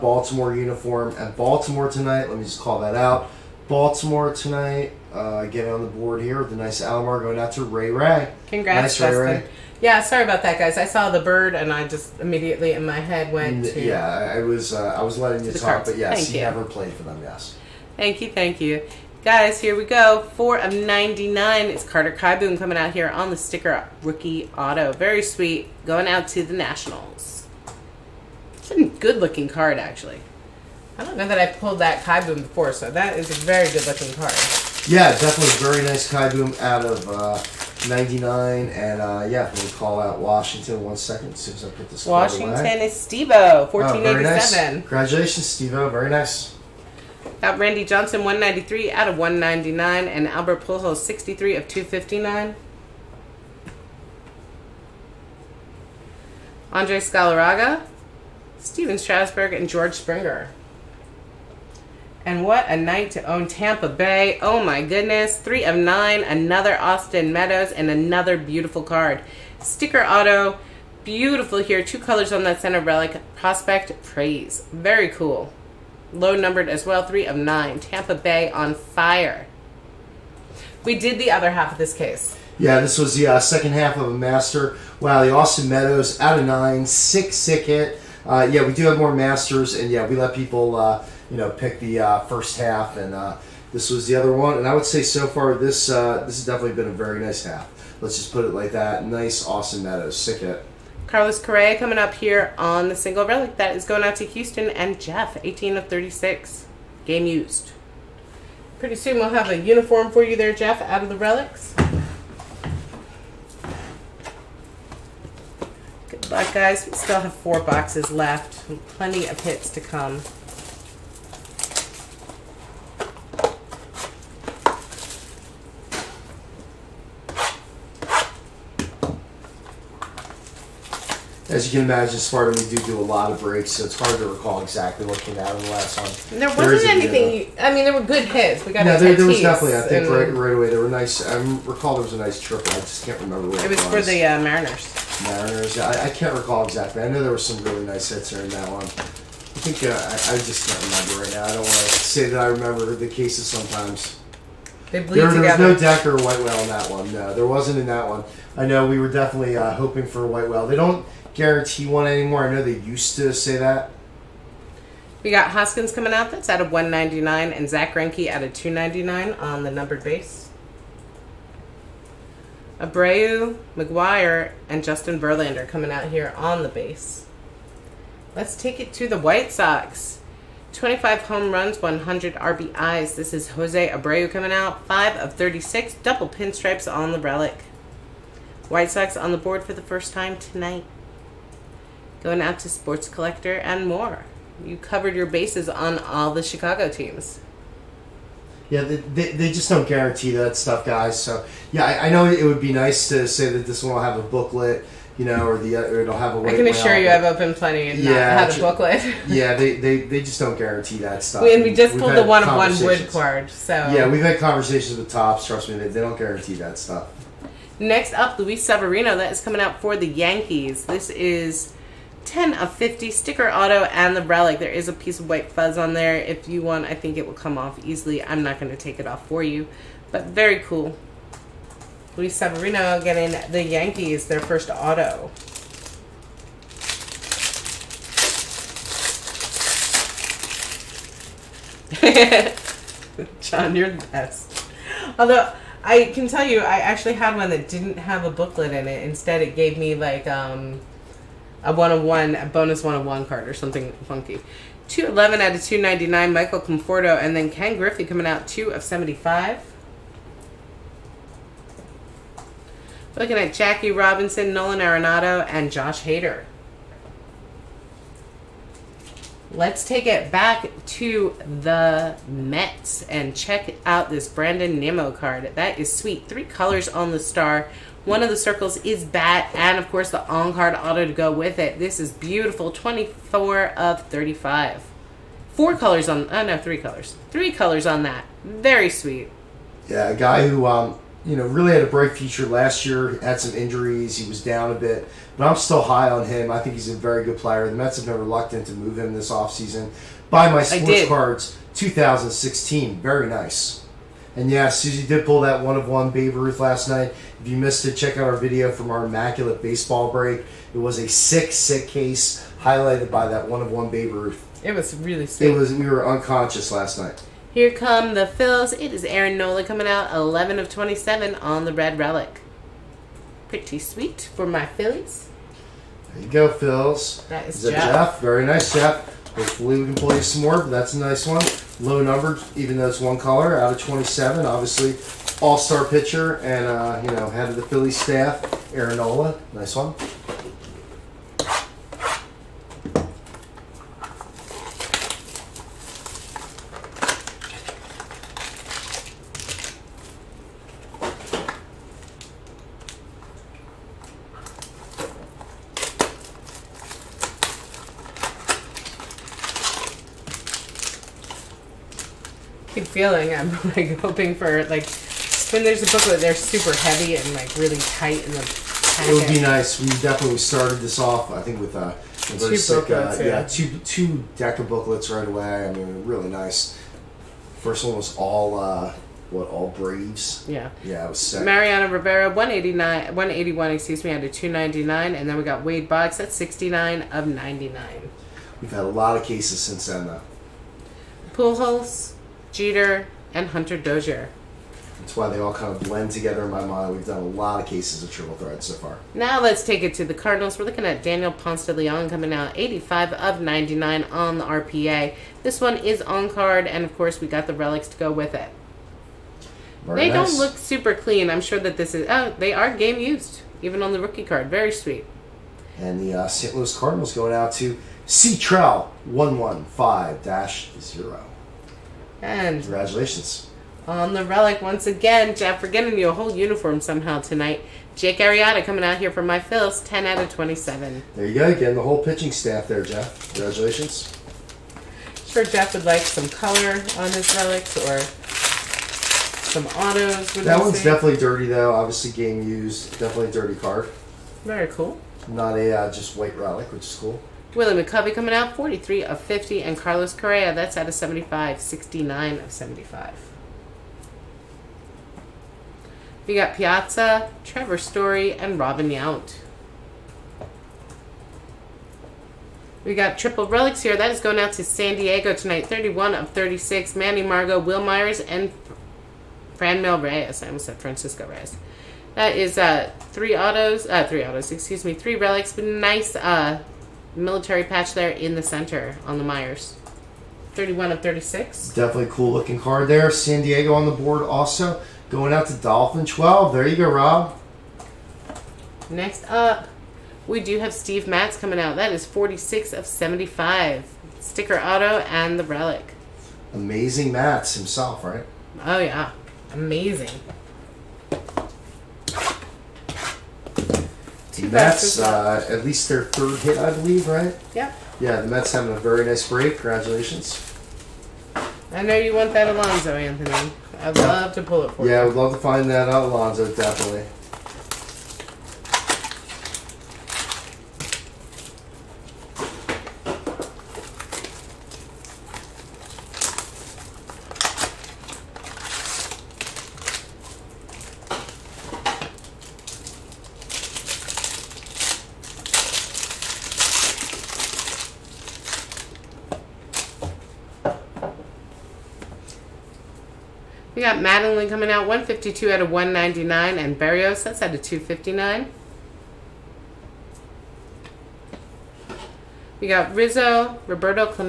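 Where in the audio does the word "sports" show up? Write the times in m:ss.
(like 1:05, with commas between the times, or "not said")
3:12, 5:00.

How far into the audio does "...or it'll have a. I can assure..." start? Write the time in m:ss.
3:25.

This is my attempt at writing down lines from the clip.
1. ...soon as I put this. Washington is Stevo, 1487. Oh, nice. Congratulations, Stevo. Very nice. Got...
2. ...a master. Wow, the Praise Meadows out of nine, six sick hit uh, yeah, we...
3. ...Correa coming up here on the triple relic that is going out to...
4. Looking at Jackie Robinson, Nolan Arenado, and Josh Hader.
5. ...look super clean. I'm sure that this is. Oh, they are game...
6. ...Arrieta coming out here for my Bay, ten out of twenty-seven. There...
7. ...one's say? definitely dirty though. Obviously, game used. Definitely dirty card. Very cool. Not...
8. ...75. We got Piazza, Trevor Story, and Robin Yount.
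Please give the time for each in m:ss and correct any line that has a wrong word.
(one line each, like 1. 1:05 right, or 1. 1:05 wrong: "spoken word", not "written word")
1. 0:41 right
2. 1:24 wrong: "Austin", not "Praise"
3. 1:41 wrong: "single", not "triple"
4. 4:23 right
5. 6:50 right
6. 7:08 wrong: "Phils", not "Bay"
7. 7:20 right
8. 7:32 right.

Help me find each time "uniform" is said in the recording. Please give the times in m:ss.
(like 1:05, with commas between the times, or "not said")
0:00, 1:49, 7:06.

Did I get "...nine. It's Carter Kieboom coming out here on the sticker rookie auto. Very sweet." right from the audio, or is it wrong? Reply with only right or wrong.
right.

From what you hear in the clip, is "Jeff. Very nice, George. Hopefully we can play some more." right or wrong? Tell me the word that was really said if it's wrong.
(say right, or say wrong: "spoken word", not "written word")
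wrong: "Jeff", not "George".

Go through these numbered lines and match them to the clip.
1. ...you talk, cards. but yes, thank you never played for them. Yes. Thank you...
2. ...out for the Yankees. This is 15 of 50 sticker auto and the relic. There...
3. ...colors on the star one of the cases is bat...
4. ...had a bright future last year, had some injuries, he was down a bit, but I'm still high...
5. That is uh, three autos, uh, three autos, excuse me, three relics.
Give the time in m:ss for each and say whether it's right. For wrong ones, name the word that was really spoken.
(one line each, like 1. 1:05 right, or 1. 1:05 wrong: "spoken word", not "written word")
1. 0:15 right
2. 3:39 wrong: "10", not "15"
3. 4:36 wrong: "circles", not "cases"
4. 4:51 right
5. 7:52 right.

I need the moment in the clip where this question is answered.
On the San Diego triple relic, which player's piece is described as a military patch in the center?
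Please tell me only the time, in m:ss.
7:59.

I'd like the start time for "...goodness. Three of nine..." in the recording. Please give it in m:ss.
1:04.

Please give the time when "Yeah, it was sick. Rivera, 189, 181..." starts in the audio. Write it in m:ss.
6:20.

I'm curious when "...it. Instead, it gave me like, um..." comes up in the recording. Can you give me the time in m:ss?
4:08.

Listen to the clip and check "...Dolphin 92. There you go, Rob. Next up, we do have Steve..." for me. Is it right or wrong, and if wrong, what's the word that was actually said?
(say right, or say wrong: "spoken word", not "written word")
wrong: "12", not "92".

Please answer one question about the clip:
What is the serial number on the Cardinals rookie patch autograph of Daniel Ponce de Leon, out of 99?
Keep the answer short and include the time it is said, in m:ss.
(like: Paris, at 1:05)
85, at 6:42.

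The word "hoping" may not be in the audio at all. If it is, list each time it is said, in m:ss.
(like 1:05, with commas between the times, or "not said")
2:39, 6:03.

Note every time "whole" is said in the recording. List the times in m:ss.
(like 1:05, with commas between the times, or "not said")
7:06, 7:11.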